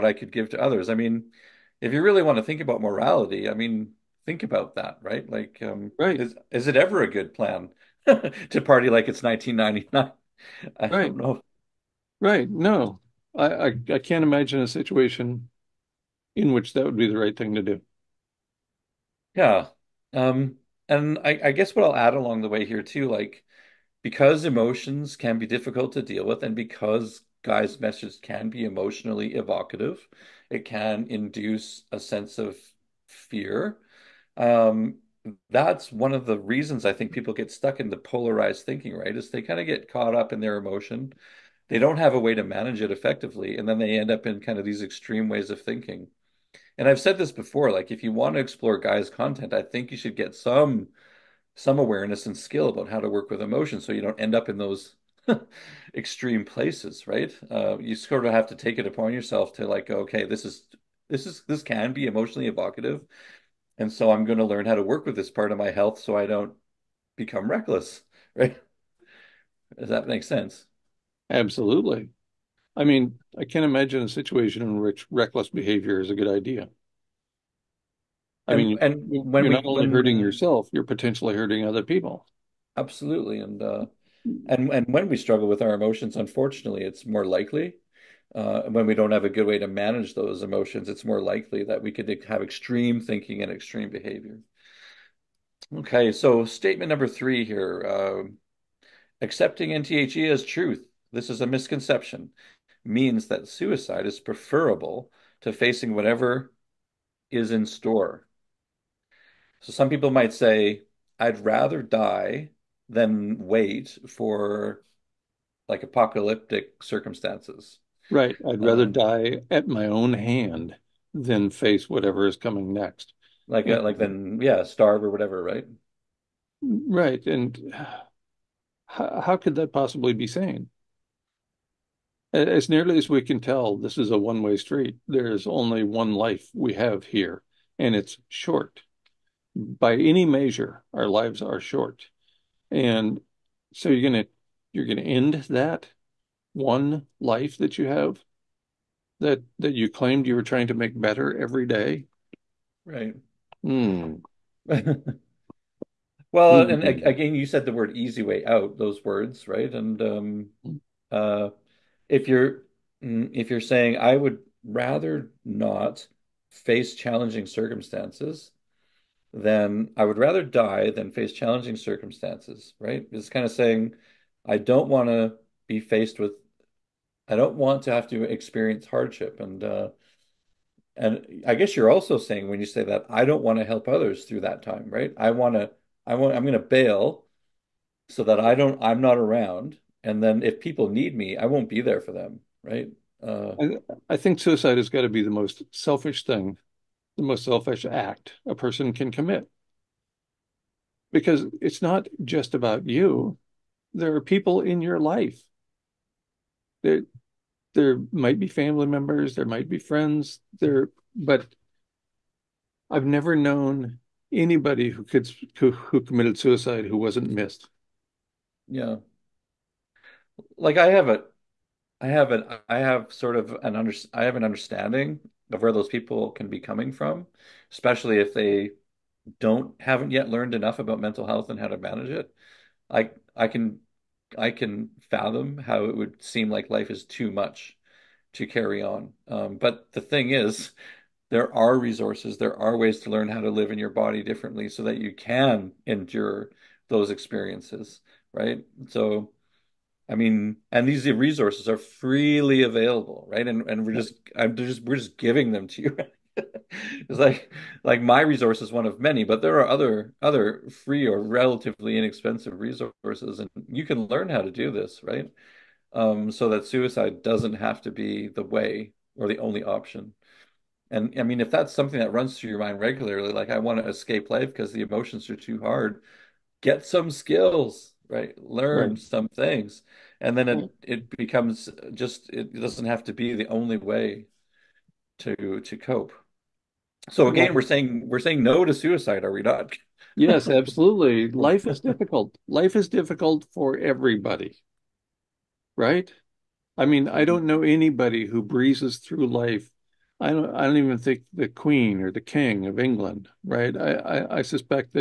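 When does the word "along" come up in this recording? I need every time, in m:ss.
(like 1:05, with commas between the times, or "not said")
0:22.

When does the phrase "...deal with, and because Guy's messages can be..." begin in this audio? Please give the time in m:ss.
0:26.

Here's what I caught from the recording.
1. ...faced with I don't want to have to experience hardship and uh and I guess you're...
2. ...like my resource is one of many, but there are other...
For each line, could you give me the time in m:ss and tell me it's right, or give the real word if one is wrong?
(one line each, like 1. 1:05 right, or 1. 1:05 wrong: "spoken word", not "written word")
1. 2:55 right
2. 4:17 right.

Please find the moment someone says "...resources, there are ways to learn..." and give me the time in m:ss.
4:01.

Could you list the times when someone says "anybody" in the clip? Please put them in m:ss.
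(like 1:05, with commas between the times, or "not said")
3:34, 4:57.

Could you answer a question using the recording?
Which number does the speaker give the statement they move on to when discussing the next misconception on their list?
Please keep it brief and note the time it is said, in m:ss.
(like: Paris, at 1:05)
3, at 1:37.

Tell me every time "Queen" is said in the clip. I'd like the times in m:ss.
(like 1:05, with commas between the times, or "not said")
5:01.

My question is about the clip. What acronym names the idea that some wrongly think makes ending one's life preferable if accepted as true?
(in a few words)
NTHE.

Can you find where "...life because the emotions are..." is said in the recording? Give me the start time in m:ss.
4:34.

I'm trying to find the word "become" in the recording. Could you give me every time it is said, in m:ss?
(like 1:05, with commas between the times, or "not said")
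1:07, 4:41.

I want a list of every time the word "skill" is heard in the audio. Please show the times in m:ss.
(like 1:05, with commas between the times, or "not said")
0:52, 4:37.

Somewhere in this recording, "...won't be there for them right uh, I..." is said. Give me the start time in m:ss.
3:11.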